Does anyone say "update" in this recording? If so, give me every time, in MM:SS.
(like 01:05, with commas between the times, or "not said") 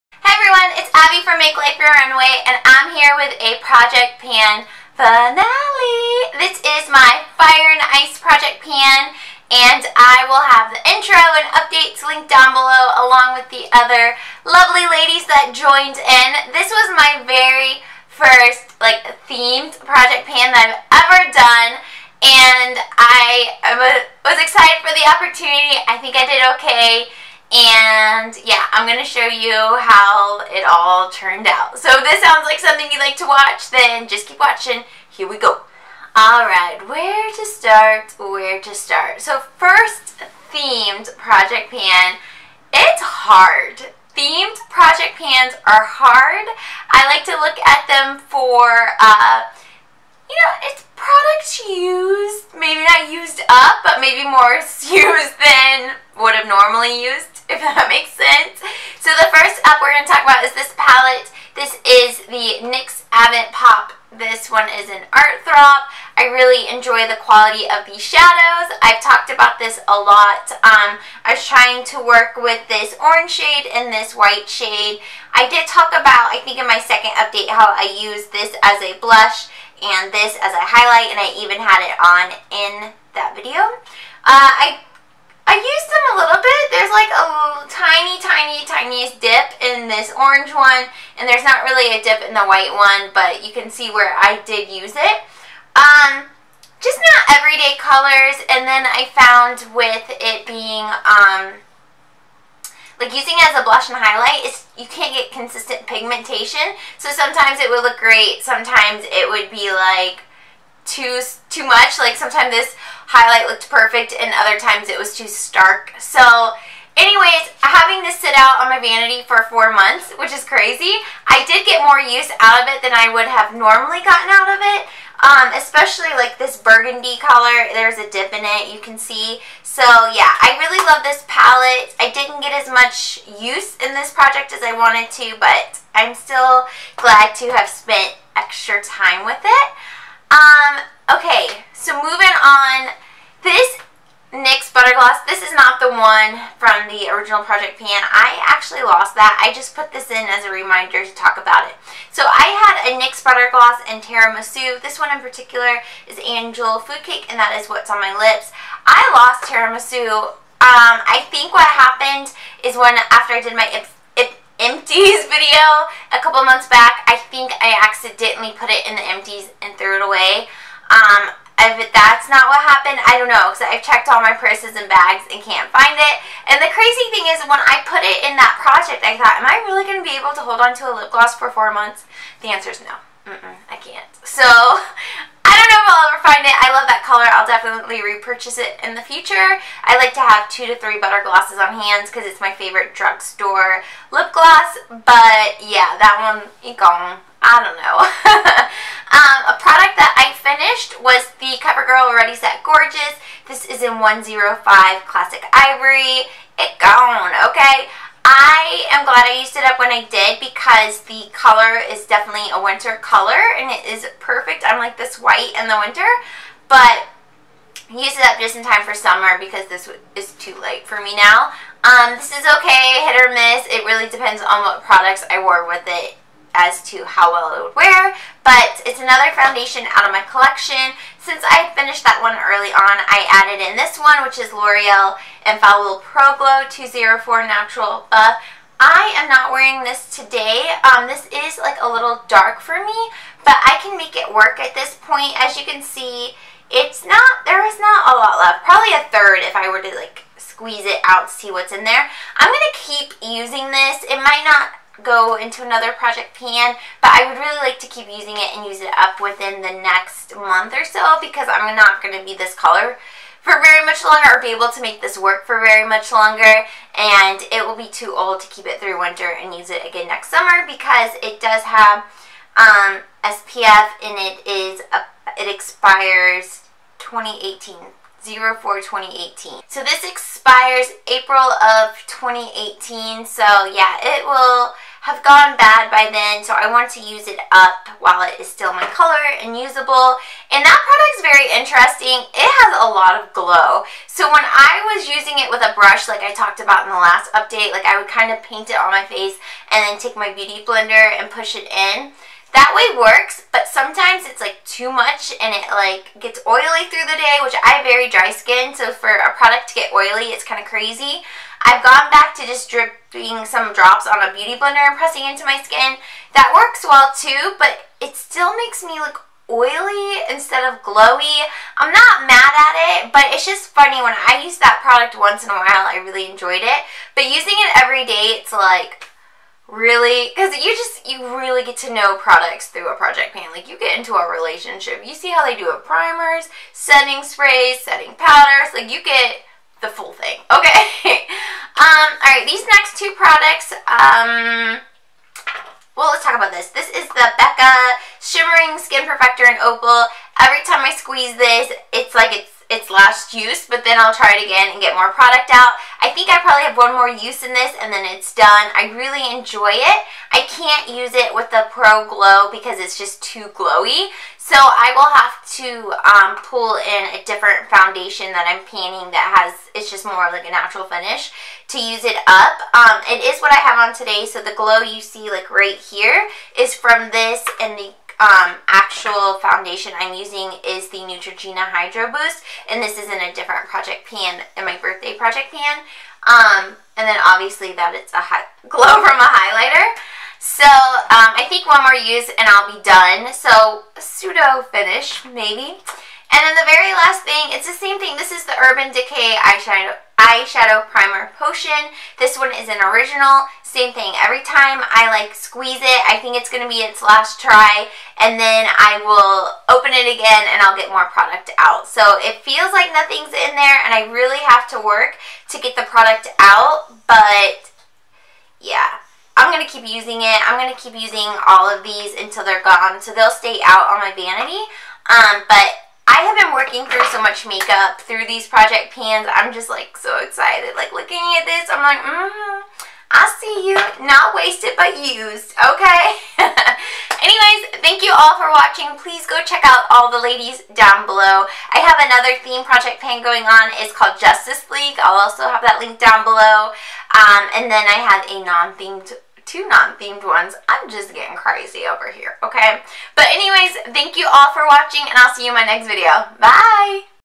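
00:11, 01:17, 04:57.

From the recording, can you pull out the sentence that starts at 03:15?
But yeah, that one, eh, gone.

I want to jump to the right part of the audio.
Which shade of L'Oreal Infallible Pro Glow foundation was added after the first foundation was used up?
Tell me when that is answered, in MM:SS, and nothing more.
03:56.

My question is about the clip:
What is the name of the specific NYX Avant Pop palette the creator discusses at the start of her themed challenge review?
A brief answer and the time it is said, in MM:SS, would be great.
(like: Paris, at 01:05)
Art Throb, at 01:05.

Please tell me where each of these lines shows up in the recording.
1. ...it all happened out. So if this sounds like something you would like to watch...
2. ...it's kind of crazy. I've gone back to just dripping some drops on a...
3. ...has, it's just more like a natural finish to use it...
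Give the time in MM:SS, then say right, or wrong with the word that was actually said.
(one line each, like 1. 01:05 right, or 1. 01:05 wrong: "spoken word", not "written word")
1. 00:30 wrong: "turned", not "happened"
2. 05:10 right
3. 06:09 right.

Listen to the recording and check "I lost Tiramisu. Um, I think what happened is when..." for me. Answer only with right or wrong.
right.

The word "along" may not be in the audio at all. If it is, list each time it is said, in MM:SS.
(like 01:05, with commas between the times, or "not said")
00:13.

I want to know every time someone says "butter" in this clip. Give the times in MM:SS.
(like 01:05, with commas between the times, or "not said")
02:33, 03:11.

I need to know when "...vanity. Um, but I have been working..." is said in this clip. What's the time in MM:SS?
07:04.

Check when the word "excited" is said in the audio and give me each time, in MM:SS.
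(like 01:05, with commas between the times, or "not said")
00:24, 07:10.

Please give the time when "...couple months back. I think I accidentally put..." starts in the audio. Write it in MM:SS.
02:46.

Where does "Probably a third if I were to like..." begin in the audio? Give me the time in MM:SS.
04:08.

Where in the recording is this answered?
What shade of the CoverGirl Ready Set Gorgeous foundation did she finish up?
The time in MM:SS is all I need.
03:23.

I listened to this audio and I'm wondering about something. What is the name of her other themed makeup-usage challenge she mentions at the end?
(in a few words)
Justice League.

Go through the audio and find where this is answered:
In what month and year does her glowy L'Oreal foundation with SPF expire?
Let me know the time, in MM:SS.
04:41.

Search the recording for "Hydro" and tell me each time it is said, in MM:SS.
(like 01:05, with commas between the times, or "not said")
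06:21.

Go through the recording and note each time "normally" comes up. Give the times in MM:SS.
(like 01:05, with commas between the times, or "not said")
00:56, 02:03.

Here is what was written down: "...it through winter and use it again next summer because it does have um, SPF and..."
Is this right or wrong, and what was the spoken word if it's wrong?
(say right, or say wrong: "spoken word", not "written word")
right.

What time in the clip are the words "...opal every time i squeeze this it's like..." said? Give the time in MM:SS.
05:49.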